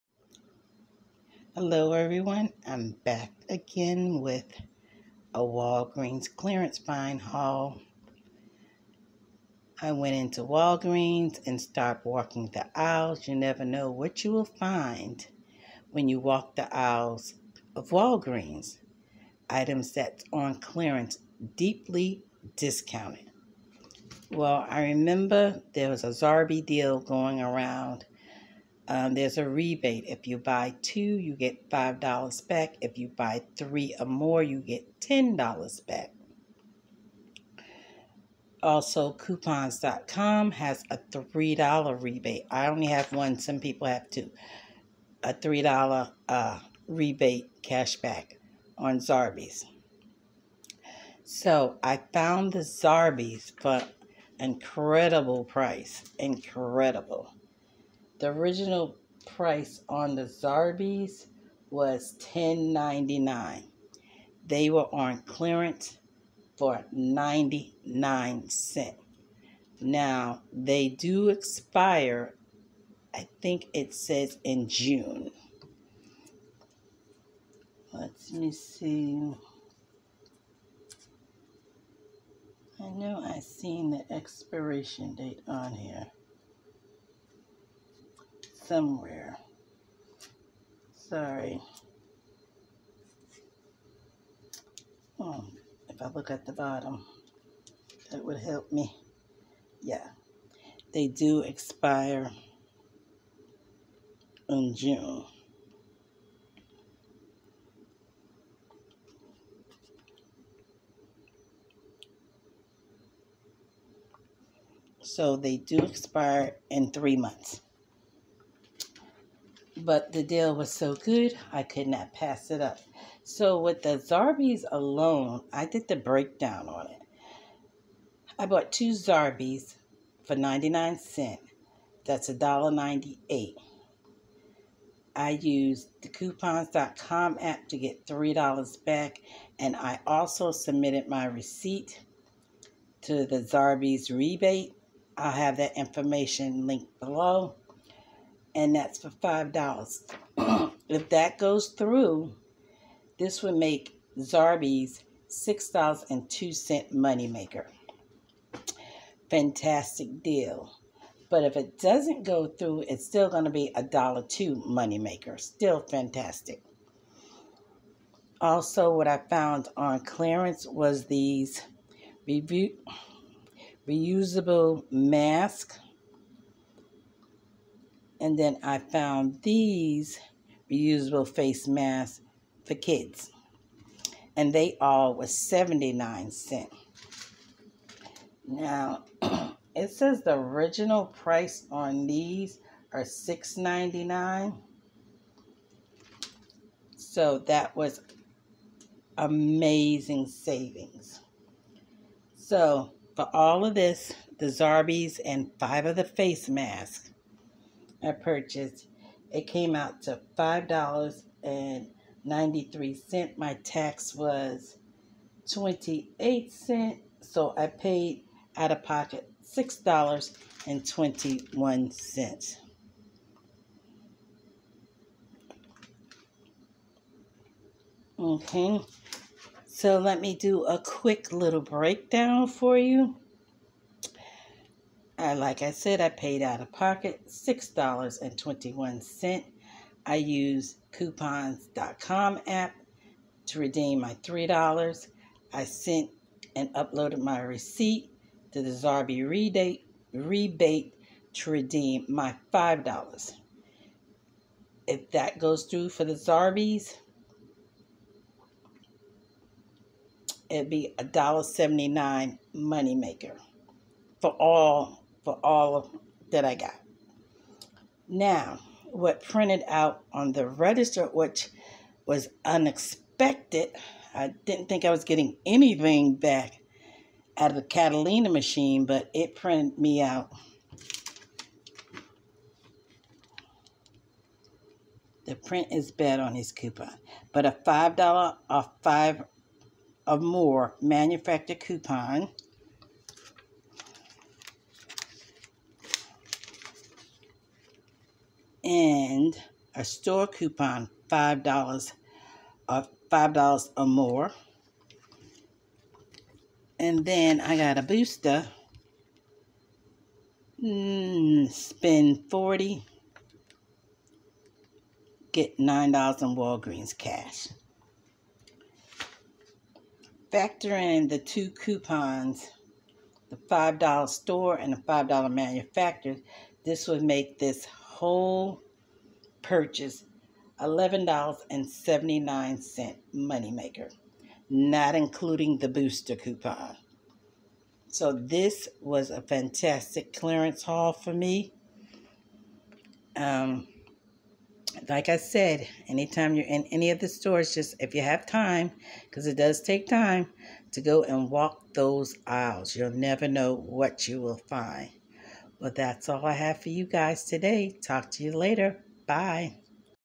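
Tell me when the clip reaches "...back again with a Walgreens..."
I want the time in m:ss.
0:03.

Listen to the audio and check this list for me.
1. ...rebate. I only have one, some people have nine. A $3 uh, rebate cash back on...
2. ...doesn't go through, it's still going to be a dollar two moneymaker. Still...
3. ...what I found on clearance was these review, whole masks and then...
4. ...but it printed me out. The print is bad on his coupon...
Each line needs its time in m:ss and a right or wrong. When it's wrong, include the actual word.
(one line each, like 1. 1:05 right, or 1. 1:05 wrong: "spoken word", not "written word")
1. 0:42 wrong: "two", not "nine"
2. 2:41 right
3. 2:48 wrong: "reusable", not "whole"
4. 4:38 right.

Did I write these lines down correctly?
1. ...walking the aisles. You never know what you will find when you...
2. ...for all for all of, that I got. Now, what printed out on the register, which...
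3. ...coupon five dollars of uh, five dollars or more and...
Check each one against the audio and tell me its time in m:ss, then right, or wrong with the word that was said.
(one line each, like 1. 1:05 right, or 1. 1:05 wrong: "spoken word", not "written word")
1. 0:12 right
2. 4:24 right
3. 5:00 right.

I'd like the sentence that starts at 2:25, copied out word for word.
I'll have that information linked below and that's for $5.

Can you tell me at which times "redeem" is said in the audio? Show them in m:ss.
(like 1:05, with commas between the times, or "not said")
4:03, 4:11.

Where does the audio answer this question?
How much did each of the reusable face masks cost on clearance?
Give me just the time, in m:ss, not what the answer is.
3:05.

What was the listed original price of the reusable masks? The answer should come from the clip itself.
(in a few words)
$6.99.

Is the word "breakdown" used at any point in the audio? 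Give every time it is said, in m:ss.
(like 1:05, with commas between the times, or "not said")
2:05, 3:51.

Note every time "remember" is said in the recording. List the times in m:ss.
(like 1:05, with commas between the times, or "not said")
0:24.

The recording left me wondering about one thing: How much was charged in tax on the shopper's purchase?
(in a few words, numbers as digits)
28 cents.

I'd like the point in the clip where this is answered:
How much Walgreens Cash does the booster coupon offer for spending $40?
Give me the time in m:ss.
5:15.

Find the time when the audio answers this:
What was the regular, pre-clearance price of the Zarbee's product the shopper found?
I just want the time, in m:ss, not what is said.
1:02.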